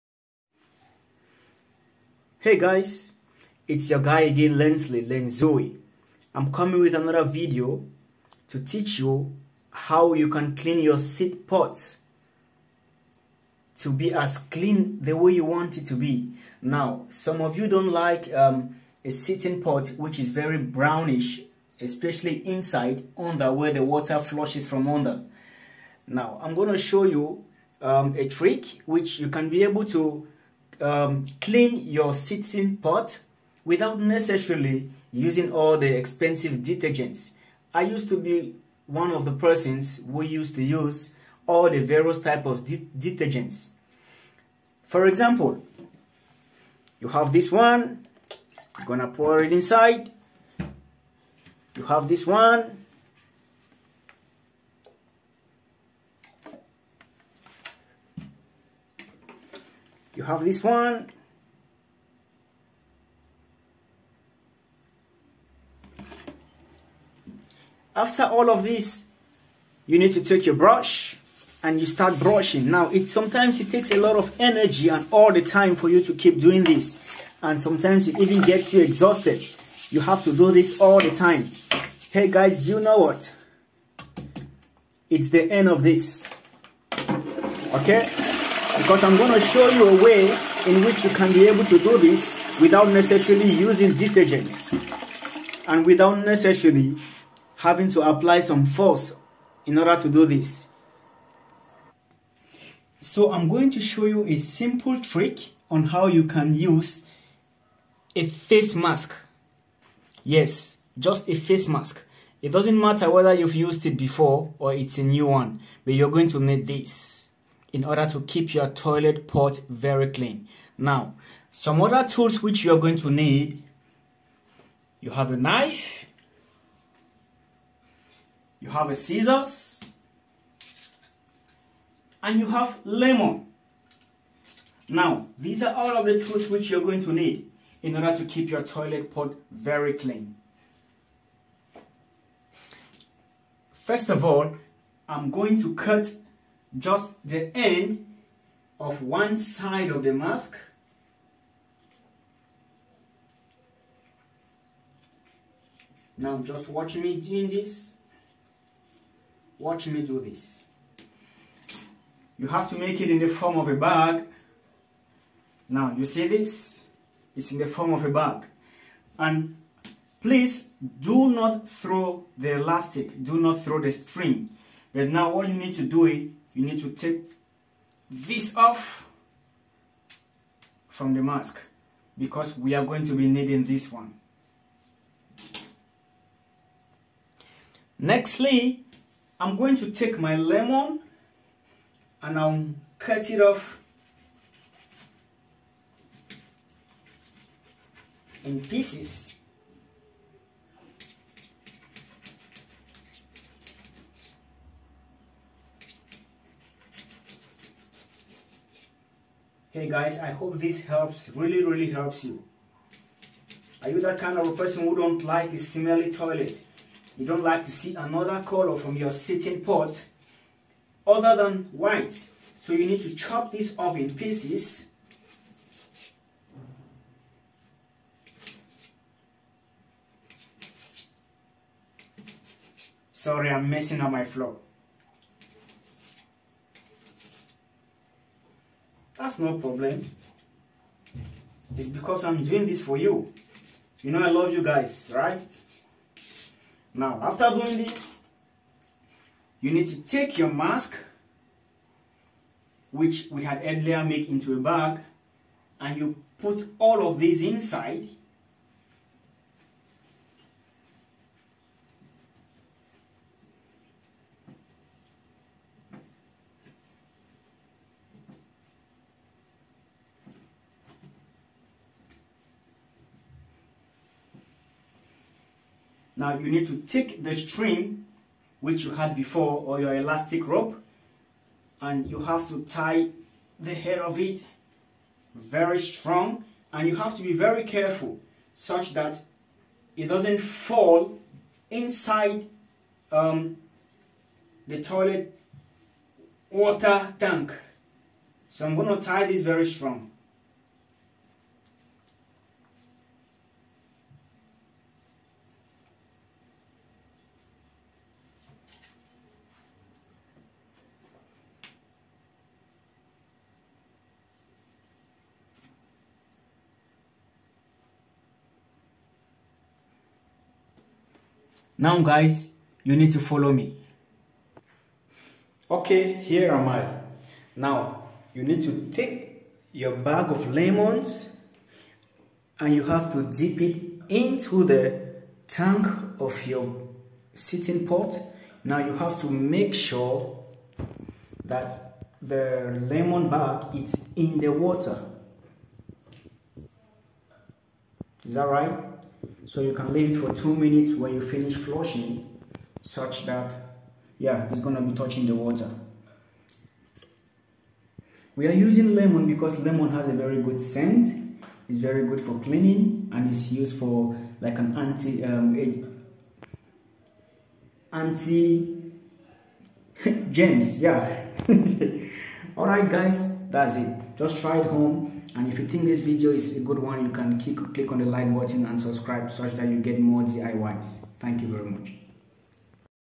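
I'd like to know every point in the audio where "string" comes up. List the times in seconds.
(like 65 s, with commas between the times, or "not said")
173 s, 277 s.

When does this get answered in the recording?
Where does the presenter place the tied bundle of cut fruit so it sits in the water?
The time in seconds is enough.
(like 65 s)
335 s.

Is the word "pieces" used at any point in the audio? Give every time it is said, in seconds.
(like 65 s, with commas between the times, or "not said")
198 s, 224 s.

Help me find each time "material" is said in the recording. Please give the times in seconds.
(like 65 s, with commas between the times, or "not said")
not said.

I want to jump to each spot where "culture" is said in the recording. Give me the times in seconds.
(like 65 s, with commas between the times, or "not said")
not said.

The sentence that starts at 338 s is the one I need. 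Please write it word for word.
Now you have to make sure that the lemon bag is in the water.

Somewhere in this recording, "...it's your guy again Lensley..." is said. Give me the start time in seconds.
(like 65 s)
3 s.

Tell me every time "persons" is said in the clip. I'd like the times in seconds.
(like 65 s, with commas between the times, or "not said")
39 s, 214 s.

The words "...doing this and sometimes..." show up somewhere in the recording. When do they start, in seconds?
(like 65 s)
76 s.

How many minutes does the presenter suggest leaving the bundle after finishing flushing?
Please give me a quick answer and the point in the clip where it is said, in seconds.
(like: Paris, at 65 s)
2, at 350 s.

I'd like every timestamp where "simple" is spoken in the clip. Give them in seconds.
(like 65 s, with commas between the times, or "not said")
104 s.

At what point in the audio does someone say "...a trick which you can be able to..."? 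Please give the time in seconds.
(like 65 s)
28 s.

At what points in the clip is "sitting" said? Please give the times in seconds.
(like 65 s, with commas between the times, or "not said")
19 s, 32 s, 219 s, 337 s.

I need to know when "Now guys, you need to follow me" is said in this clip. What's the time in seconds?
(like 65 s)
321 s.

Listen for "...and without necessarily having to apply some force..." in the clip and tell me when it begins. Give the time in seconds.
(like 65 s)
95 s.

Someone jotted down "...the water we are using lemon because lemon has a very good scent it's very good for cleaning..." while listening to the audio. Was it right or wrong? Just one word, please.
right.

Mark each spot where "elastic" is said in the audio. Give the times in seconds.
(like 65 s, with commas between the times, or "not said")
172 s, 279 s.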